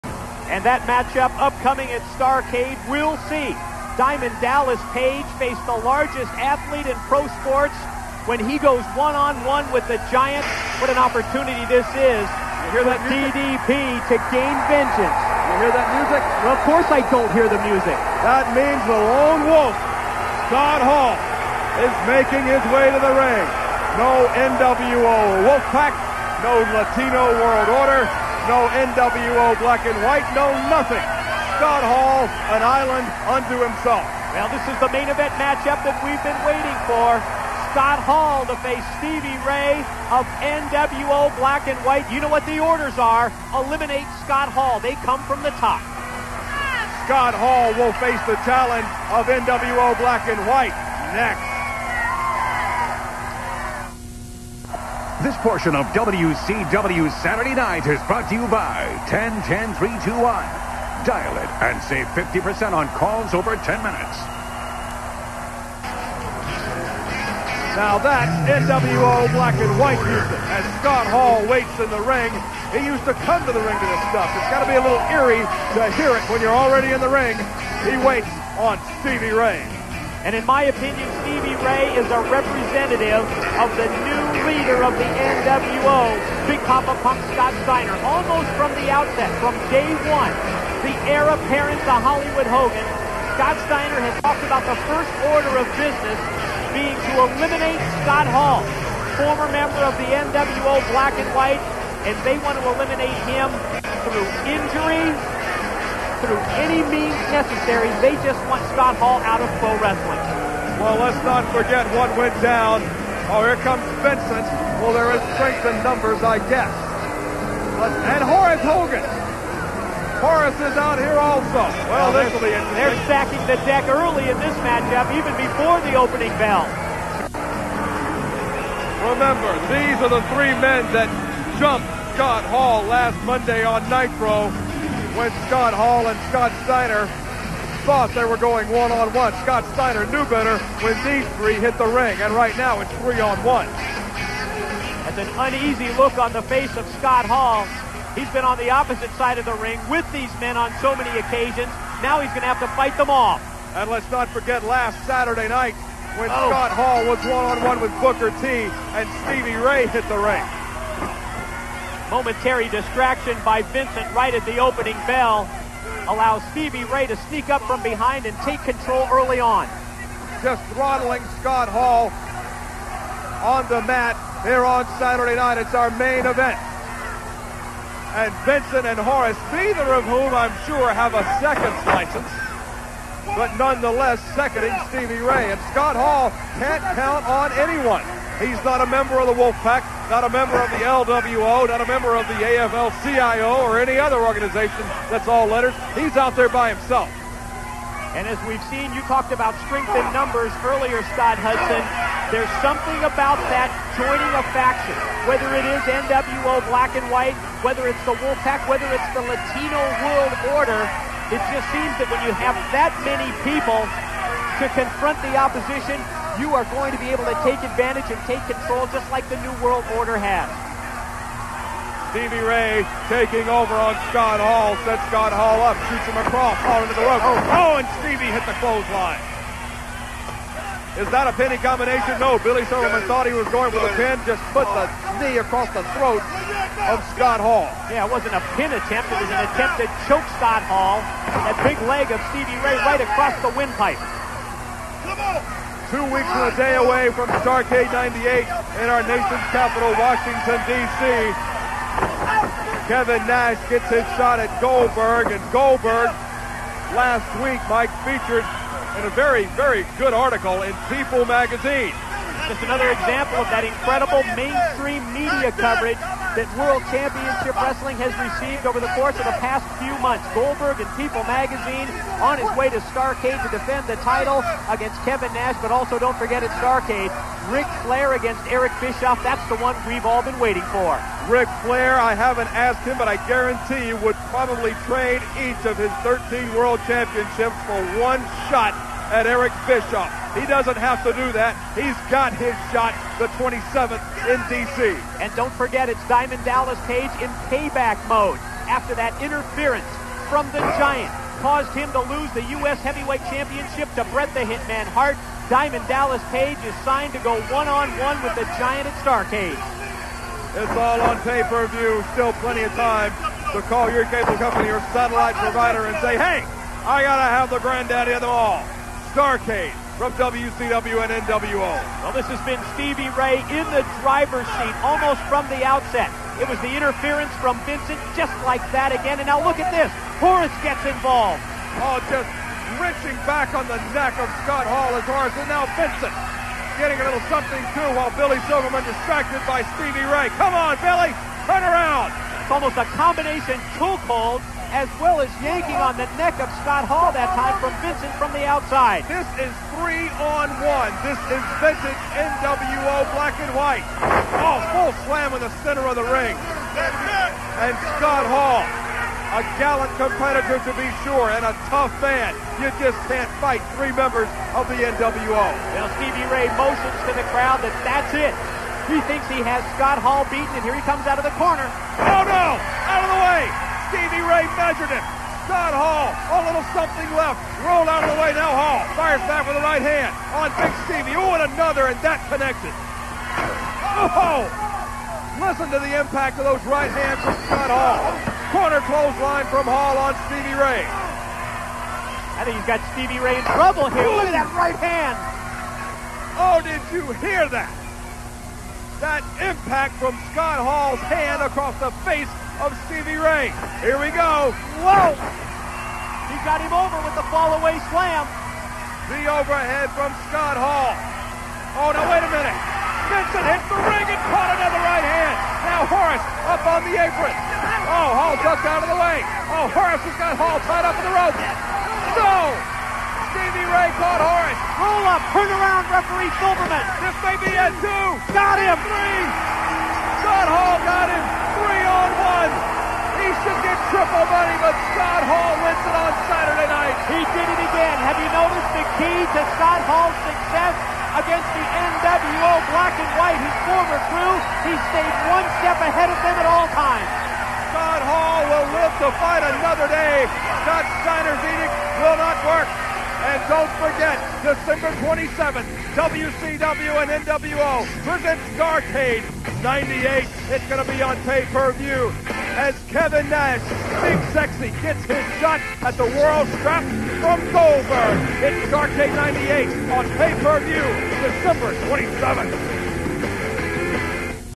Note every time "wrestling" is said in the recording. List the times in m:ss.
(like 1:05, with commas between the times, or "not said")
1:49, 4:27.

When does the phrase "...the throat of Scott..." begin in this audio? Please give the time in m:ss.
3:55.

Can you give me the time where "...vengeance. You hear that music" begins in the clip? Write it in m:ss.
0:14.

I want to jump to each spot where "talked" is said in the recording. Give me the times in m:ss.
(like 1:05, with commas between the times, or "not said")
1:34, 3:19.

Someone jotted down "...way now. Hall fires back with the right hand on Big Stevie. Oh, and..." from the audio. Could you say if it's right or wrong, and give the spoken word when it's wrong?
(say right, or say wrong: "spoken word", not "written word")
right.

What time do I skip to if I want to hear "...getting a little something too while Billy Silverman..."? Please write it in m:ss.
5:36.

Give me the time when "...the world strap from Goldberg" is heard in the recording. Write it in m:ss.
7:45.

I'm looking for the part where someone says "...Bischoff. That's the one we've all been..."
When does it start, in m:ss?
4:38.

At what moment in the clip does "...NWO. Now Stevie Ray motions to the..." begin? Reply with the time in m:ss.
6:04.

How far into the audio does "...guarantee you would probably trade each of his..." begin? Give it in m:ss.
4:43.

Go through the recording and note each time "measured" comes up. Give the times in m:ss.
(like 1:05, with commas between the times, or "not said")
6:14.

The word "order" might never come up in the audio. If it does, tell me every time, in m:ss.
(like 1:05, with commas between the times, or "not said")
0:27, 0:42, 1:35, 3:30, 3:39.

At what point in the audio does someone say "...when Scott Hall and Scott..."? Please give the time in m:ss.
2:15.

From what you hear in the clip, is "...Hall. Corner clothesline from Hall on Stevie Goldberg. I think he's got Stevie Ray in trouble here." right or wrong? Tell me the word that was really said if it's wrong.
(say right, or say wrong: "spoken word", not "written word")
wrong: "Ray", not "Goldberg".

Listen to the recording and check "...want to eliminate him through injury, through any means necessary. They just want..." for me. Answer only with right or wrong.
right.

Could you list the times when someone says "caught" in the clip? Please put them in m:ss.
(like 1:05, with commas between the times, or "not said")
6:54, 7:03.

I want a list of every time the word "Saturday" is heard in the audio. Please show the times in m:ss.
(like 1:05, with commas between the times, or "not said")
0:57, 2:35, 2:54, 7:16.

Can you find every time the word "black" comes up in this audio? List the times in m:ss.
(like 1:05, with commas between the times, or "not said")
0:29, 0:41, 0:49, 1:09, 1:40, 3:26, 5:53, 7:22.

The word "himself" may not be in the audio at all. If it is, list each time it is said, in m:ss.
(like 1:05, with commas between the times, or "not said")
0:33, 3:16.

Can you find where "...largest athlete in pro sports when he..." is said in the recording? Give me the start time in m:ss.
0:05.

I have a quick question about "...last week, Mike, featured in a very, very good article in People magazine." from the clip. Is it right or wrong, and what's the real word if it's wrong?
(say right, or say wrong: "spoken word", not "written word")
right.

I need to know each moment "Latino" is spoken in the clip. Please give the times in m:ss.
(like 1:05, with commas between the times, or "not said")
0:26, 3:29.